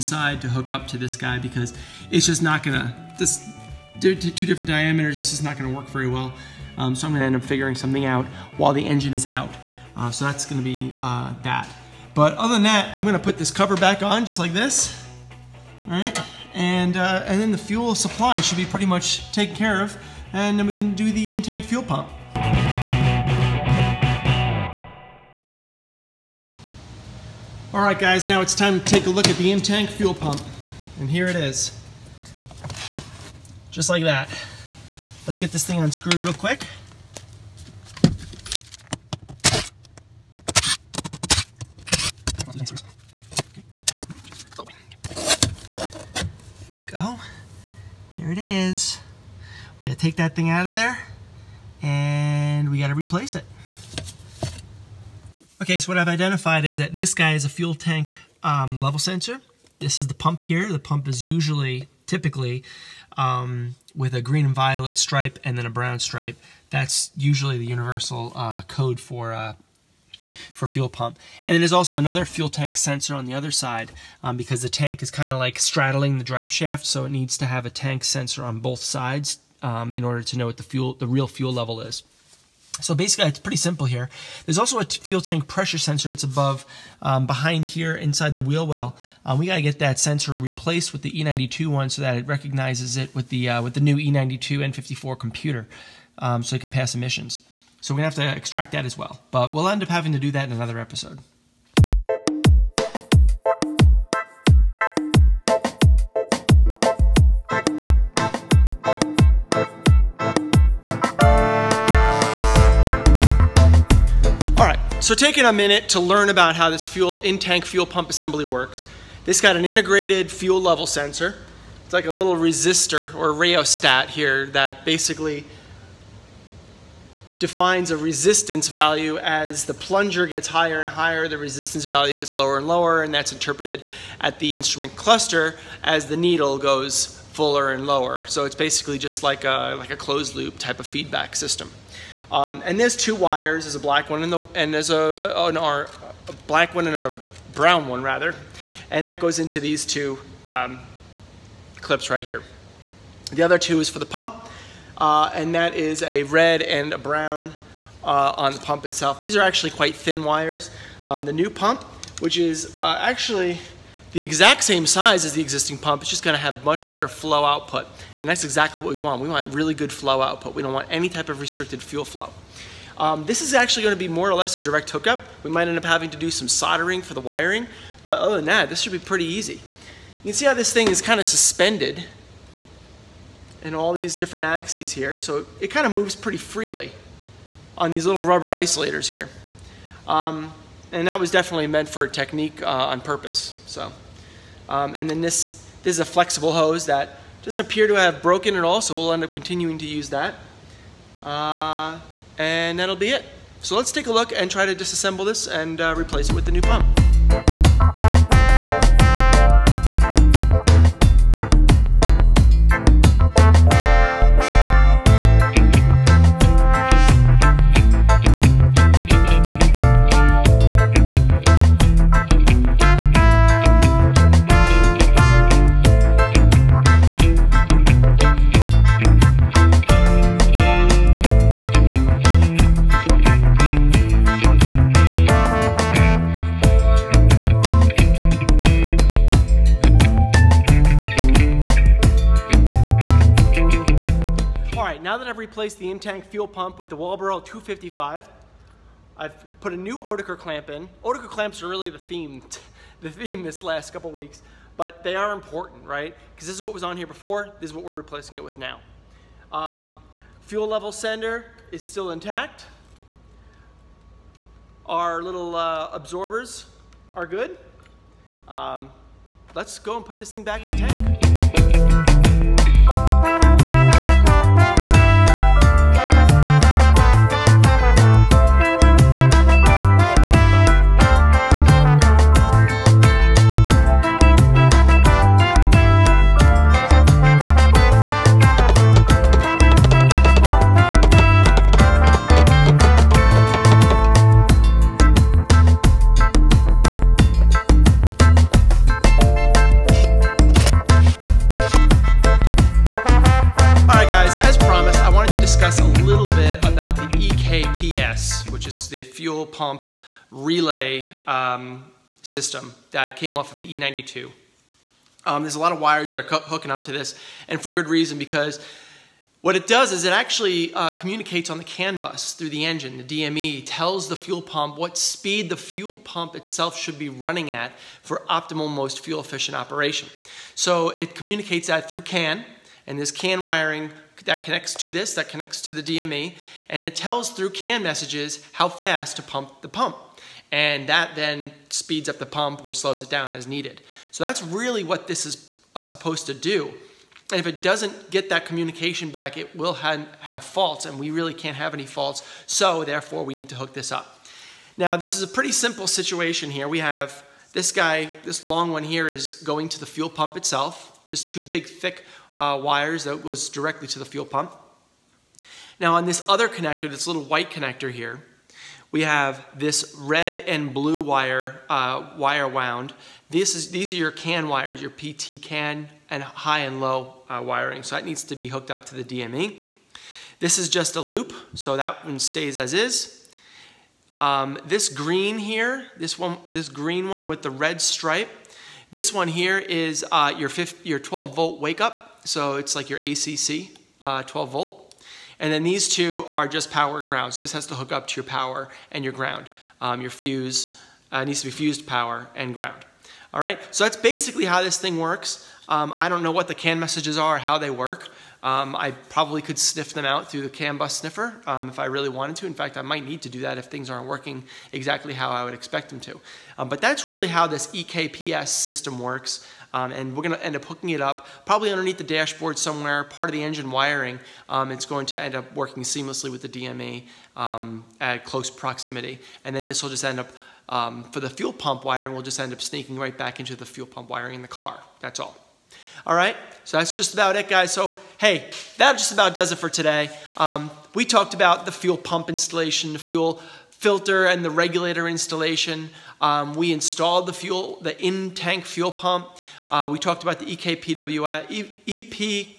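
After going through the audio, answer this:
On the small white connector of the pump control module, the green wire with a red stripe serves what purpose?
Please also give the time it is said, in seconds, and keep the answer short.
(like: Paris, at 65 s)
12 volt wake up, at 390 s.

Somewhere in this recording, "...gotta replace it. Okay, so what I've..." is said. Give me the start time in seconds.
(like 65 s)
52 s.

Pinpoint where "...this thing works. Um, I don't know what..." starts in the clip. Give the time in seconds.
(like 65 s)
404 s.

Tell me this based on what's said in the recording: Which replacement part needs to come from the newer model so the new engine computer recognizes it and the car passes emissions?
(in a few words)
Fuel tank pressure sensor.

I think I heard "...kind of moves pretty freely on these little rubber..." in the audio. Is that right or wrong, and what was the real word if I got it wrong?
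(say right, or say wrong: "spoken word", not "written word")
right.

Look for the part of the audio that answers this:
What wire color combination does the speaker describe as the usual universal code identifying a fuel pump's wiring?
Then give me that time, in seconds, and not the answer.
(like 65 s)
64 s.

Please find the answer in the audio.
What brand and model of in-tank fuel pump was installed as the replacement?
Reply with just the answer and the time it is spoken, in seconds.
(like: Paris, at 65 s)
Walbro 255, at 246 s.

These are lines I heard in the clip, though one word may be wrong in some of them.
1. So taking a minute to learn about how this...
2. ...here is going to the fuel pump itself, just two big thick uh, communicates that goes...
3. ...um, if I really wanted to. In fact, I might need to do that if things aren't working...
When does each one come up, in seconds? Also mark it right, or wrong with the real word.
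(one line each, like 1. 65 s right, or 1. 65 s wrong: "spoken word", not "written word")
1. 114 s right
2. 358 s wrong: "wires", not "communicates"
3. 411 s right.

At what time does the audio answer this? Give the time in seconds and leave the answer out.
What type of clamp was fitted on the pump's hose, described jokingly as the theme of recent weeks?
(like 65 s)
249 s.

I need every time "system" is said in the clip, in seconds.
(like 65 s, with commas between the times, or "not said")
141 s, 312 s, 418 s.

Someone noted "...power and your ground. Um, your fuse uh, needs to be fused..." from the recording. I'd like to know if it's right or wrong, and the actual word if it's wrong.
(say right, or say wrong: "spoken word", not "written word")
right.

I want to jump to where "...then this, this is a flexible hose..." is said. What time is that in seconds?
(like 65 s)
195 s.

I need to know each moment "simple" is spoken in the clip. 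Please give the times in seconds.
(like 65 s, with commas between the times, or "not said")
83 s, 355 s.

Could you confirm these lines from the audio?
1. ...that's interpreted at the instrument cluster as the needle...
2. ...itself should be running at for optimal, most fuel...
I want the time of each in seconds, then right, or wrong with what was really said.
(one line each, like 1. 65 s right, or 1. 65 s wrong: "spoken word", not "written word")
1. 133 s right
2. 326 s right.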